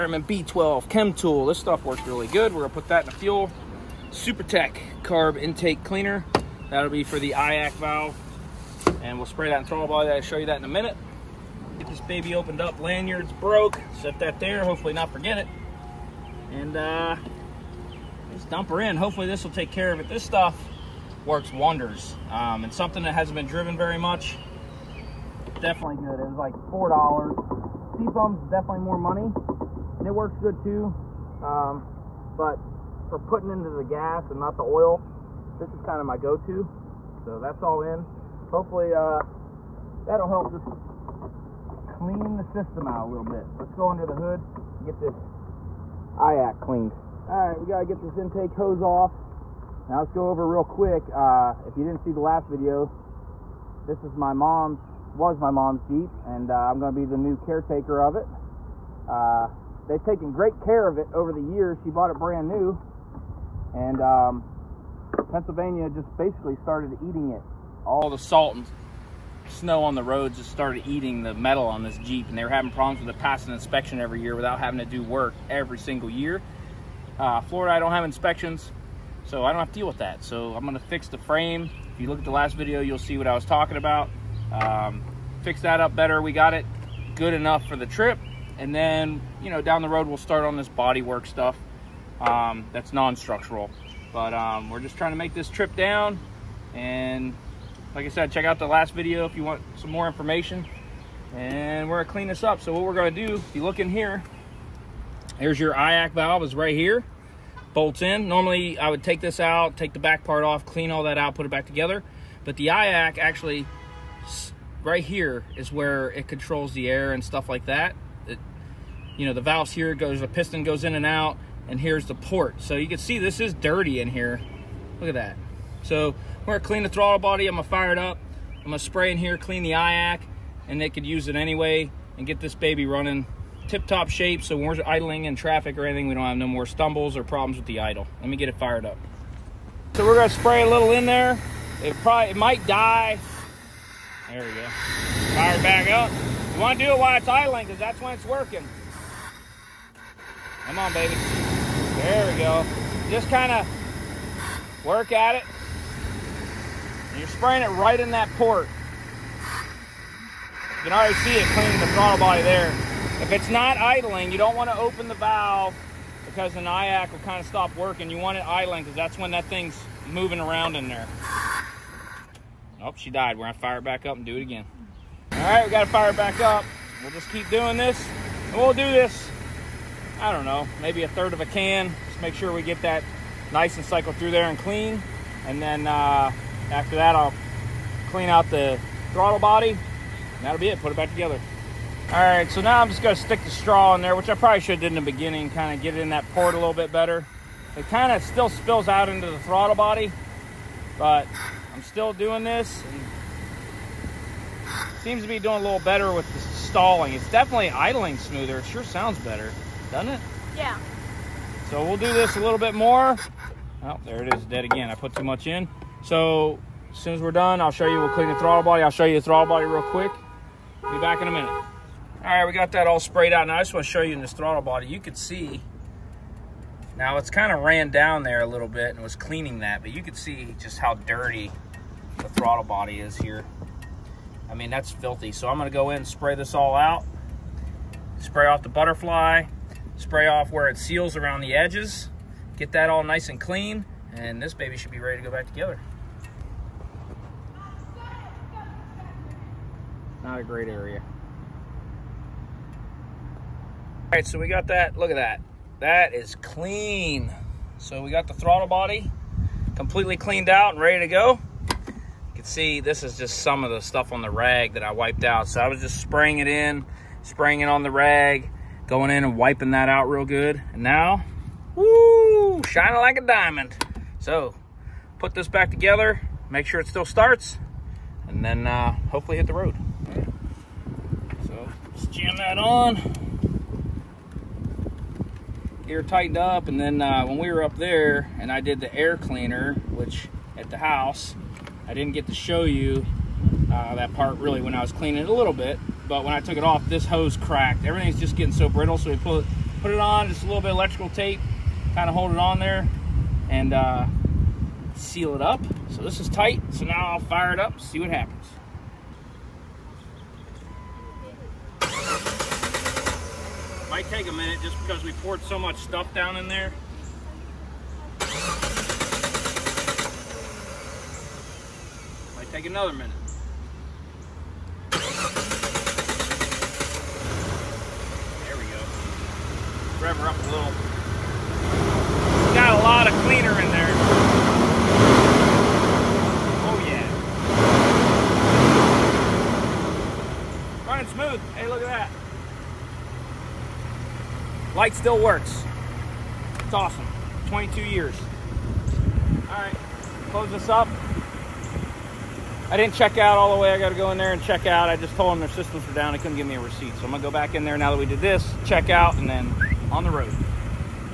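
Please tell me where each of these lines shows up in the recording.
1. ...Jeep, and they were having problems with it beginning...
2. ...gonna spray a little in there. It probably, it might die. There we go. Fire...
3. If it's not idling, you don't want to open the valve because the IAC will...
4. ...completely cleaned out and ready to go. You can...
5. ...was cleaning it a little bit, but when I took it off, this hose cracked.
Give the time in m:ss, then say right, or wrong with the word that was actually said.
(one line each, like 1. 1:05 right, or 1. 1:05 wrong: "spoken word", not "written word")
1. 1:11 wrong: "passing", not "beginning"
2. 2:20 right
3. 2:43 right
4. 4:19 right
5. 4:54 right.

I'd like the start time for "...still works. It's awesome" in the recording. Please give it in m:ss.
5:44.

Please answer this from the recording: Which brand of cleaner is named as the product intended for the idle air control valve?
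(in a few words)
Supertech.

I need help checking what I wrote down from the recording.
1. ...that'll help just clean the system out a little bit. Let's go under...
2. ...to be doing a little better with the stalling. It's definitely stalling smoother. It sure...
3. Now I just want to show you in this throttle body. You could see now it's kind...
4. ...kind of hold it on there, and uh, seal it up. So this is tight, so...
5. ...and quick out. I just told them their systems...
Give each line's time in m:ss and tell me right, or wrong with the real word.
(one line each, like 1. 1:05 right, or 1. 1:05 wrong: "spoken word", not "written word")
1. 0:40 right
2. 3:25 wrong: "idling", not "stalling"
3. 3:43 right
4. 5:01 right
5. 5:54 wrong: "check", not "quick".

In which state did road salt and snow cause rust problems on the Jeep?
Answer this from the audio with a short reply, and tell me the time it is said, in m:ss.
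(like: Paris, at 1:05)
Pennsylvania, at 1:05.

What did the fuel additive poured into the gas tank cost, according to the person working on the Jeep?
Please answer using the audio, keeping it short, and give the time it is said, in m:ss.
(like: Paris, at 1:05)
$4, at 0:26.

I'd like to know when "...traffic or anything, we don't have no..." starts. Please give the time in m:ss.
2:15.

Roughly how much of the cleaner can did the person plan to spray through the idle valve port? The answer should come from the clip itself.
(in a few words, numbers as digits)
a third of a can.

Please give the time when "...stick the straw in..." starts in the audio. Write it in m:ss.
3:13.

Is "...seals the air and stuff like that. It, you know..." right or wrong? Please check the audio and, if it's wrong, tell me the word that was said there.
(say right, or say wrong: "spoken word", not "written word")
wrong: "controls", not "seals".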